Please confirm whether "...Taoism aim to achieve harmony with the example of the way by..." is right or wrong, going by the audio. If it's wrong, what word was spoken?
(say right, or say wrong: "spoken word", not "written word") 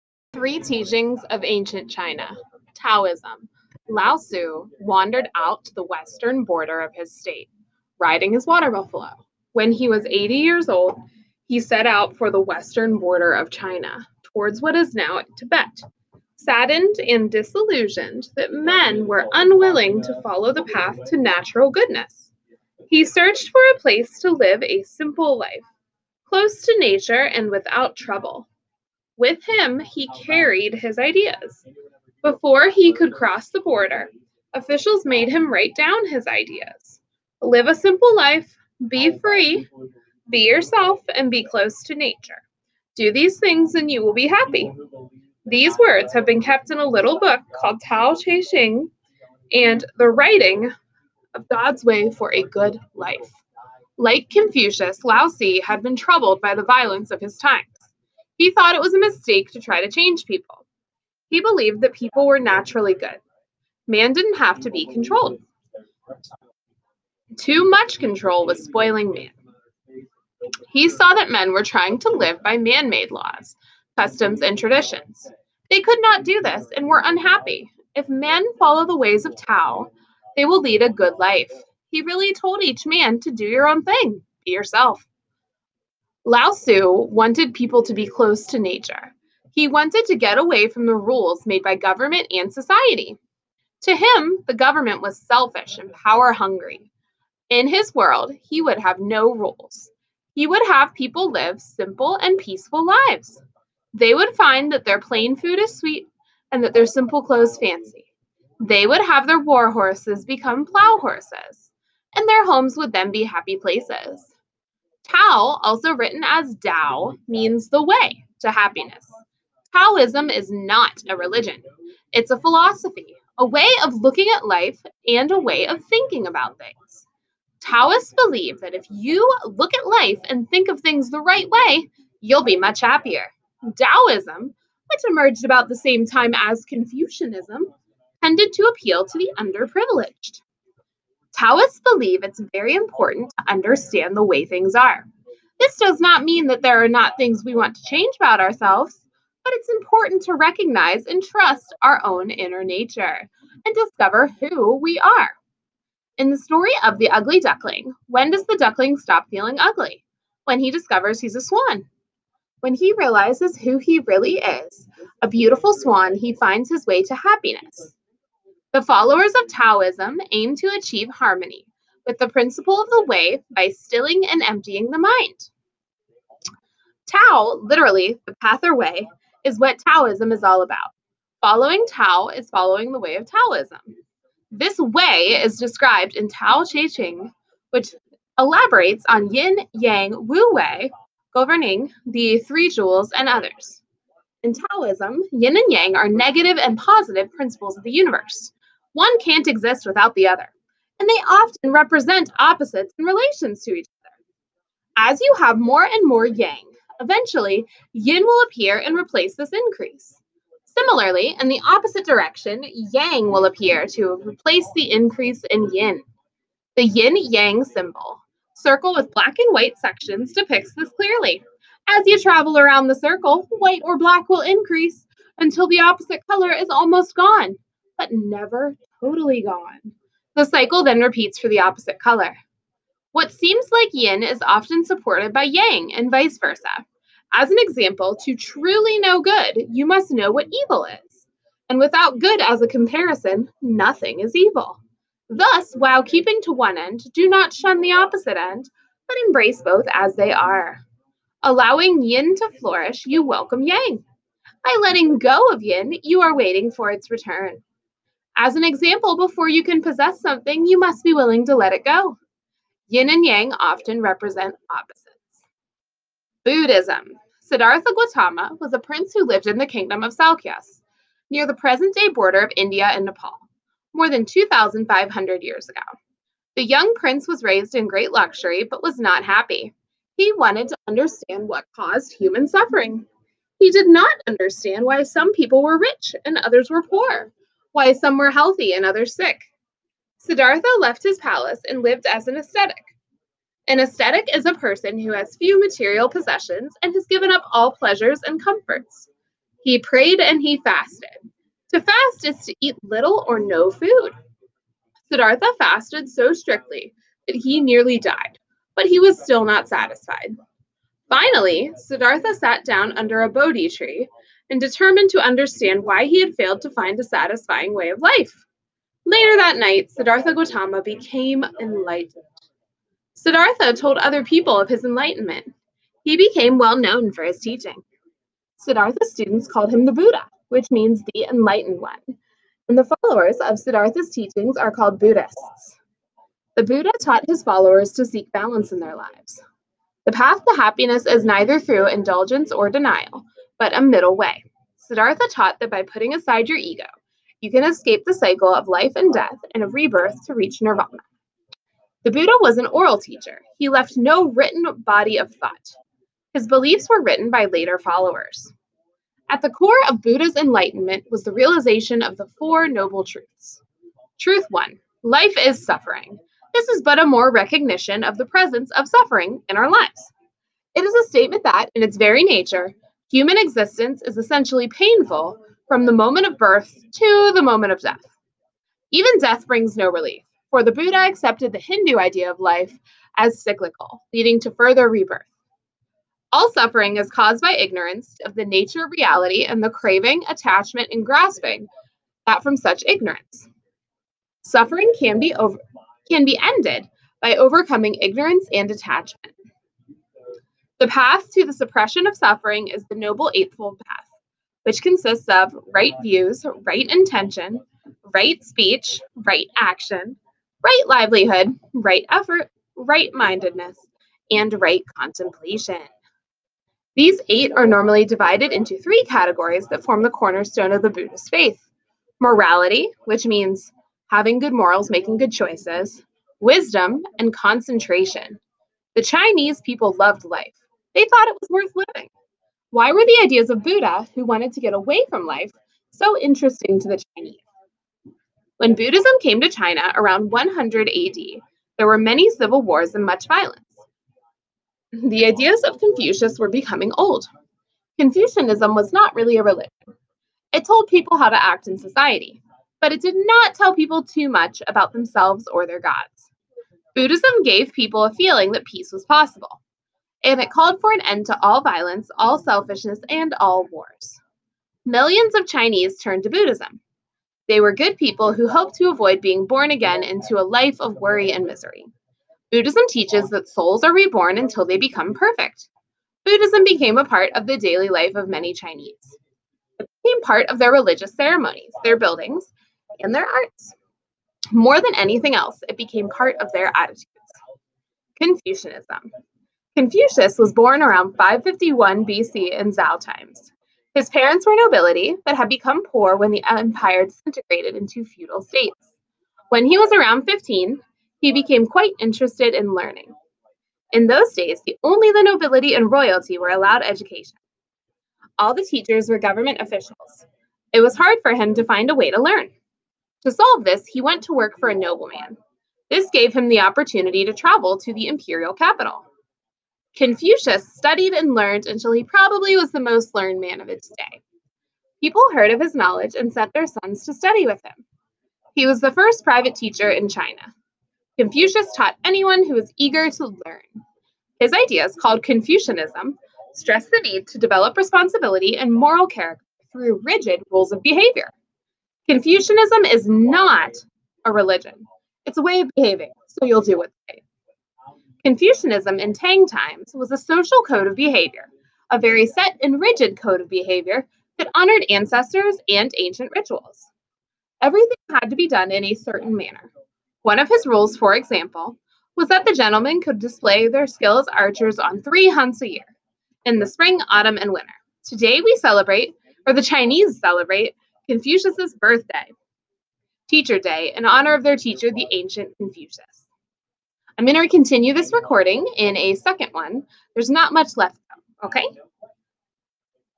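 wrong: "principle", not "example".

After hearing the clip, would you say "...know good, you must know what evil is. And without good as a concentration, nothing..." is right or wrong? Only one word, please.
wrong.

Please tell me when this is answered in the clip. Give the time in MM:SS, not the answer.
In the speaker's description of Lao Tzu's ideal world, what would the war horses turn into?
01:50.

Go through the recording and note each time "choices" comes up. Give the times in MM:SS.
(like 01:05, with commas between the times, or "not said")
07:05.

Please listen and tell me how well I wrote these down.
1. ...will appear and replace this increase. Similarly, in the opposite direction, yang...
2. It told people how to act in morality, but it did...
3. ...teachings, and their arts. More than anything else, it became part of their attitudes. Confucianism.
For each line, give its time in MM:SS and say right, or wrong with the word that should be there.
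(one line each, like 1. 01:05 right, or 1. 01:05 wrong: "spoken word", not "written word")
1. 03:28 right
2. 07:30 wrong: "society", not "morality"
3. 08:01 wrong: "buildings", not "teachings".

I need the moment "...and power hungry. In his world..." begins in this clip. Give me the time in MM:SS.
01:35.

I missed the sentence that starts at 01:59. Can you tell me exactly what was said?
Taoism is not a religion, it's a philosophy, a way of looking at life and a way of thinking about things.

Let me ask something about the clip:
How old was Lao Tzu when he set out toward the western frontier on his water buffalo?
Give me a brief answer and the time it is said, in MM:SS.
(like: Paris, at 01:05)
80, at 00:10.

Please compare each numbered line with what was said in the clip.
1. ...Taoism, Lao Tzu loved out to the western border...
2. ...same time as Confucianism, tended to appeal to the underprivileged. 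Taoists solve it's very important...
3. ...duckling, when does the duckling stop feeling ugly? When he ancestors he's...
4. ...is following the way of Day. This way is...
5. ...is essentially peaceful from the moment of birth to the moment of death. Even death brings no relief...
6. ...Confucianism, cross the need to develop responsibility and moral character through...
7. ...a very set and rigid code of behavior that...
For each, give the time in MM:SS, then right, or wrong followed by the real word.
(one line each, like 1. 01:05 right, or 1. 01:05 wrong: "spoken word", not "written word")
1. 00:02 wrong: "wandered", not "loved"
2. 02:15 wrong: "believe", not "solve"
3. 02:37 wrong: "discovers", not "ancestors"
4. 03:02 wrong: "Taoism", not "Day"
5. 06:14 wrong: "painful", not "peaceful"
6. 08:55 wrong: "stress", not "cross"
7. 09:11 right.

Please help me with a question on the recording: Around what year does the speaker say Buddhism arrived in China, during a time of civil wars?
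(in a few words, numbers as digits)
100 AD.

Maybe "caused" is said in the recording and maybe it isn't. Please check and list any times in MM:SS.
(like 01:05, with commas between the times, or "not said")
04:41, 06:27.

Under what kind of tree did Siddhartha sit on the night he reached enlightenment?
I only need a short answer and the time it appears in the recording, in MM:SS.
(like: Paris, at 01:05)
Bodhi tree, at 05:13.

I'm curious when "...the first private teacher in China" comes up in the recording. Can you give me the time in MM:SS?
08:48.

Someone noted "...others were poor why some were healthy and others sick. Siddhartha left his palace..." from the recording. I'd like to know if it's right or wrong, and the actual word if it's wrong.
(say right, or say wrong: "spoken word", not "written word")
right.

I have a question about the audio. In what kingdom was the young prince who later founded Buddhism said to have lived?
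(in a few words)
Salukyas.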